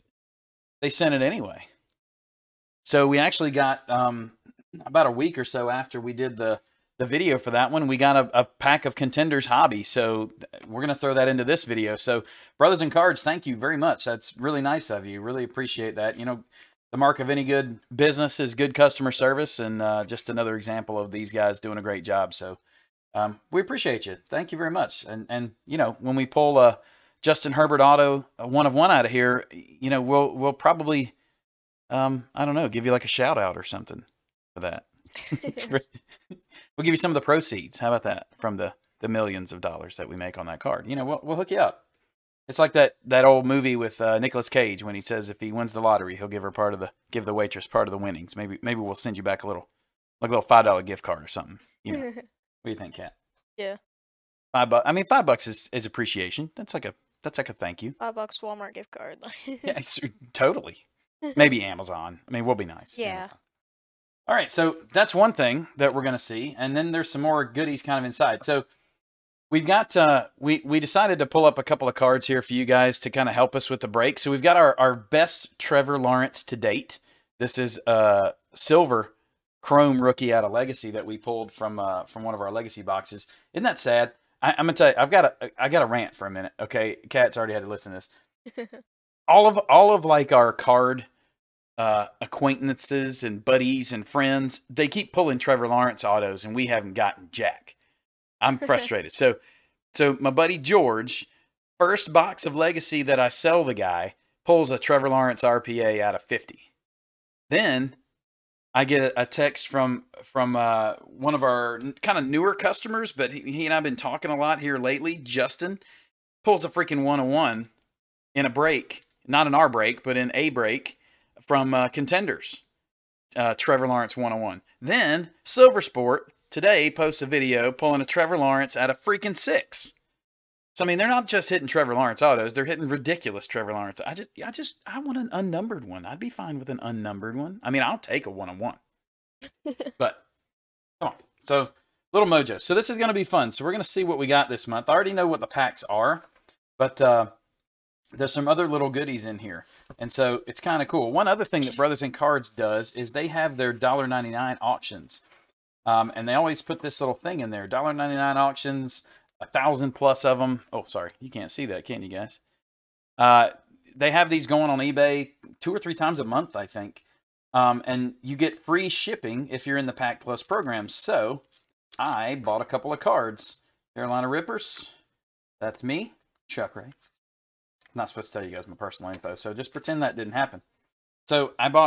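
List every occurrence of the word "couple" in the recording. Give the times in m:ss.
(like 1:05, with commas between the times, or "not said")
1:11, 2:52.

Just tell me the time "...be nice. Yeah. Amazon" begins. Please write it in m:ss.
1:02.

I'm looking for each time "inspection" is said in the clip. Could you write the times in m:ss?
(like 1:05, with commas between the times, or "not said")
not said.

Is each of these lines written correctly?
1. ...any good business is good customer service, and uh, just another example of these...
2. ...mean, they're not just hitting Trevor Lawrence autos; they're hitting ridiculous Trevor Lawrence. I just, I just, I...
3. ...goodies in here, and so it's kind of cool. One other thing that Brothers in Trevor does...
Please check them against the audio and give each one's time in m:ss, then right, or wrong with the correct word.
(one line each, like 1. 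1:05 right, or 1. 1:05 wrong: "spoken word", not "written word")
1. 0:17 right
2. 2:10 right
3. 2:28 wrong: "Cards", not "Trevor".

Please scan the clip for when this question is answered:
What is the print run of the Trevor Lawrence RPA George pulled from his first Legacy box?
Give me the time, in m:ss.
1:46.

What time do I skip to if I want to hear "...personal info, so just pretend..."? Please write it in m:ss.
2:58.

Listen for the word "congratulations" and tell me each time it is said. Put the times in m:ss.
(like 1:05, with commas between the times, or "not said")
not said.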